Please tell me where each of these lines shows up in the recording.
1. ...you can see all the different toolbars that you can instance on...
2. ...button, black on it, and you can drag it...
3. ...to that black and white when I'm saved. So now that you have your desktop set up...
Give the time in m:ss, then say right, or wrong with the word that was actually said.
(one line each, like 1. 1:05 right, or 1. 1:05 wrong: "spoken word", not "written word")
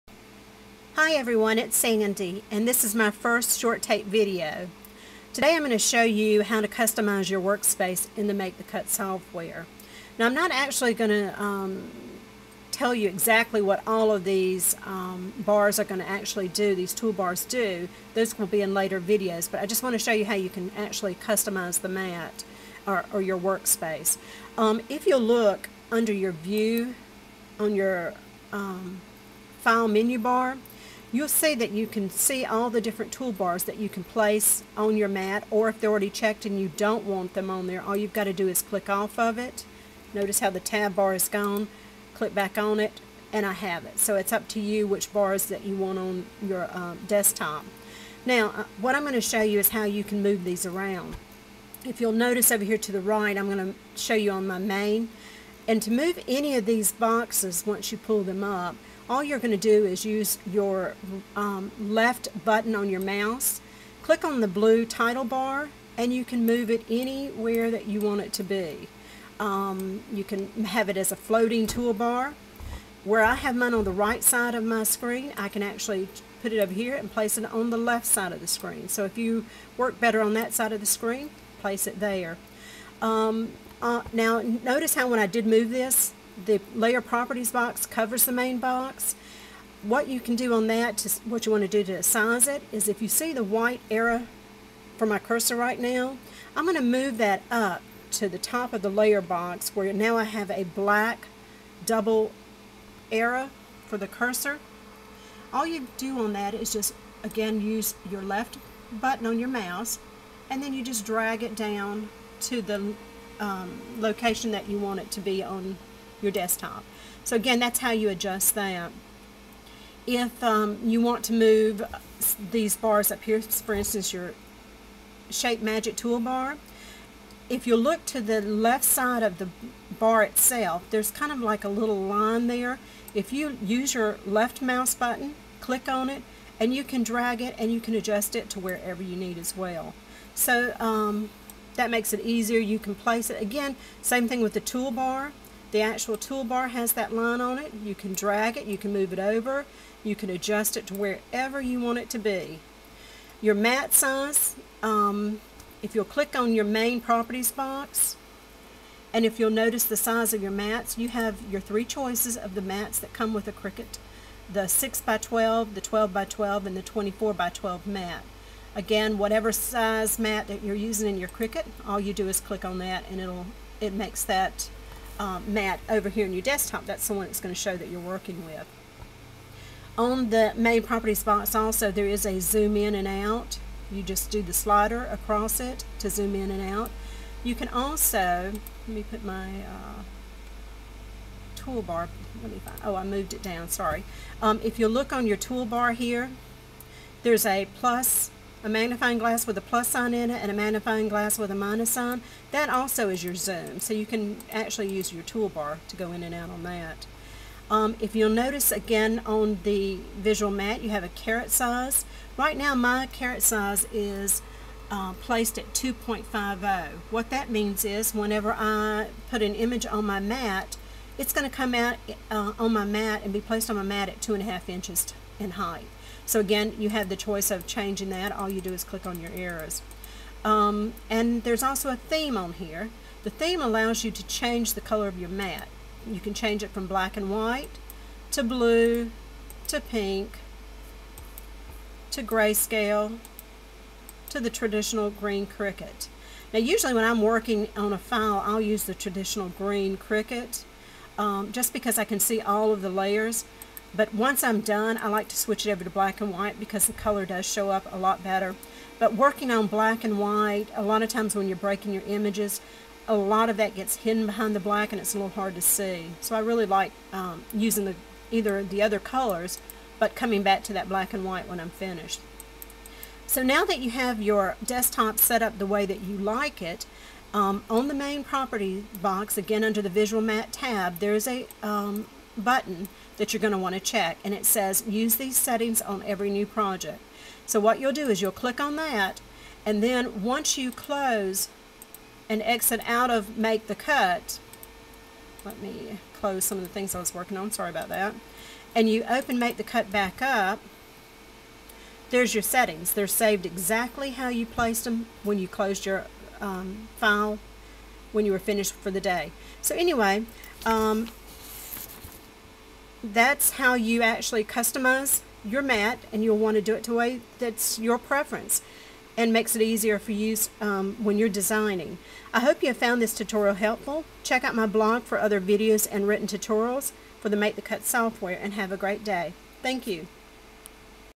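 1. 0:31 wrong: "place", not "instance"
2. 2:14 wrong: "click", not "black"
3. 4:30 wrong: "finished", not "saved".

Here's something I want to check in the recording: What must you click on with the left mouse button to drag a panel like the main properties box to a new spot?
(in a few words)
Blue title bar.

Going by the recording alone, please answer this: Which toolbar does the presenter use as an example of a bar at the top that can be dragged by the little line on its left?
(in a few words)
Shape Magic toolbar.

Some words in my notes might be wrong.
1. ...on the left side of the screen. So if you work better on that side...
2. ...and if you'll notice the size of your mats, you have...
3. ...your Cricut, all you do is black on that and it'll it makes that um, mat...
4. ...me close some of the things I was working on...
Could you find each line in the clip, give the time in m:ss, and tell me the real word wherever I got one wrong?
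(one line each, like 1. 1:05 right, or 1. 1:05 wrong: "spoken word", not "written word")
1. 1:17 right
2. 2:39 right
3. 2:51 wrong: "click", not "black"
4. 4:55 right.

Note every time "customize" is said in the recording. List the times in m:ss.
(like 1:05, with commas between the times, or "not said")
0:06, 0:21, 5:14.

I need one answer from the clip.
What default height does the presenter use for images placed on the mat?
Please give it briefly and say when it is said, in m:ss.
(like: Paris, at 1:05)
2.50, at 3:35.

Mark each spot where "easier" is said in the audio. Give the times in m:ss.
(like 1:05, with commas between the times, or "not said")
2:22, 5:19.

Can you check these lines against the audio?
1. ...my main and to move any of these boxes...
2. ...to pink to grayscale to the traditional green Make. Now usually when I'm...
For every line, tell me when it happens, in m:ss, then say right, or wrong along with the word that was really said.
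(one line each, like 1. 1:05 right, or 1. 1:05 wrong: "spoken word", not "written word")
1. 0:54 right
2. 3:59 wrong: "Cricut", not "Make".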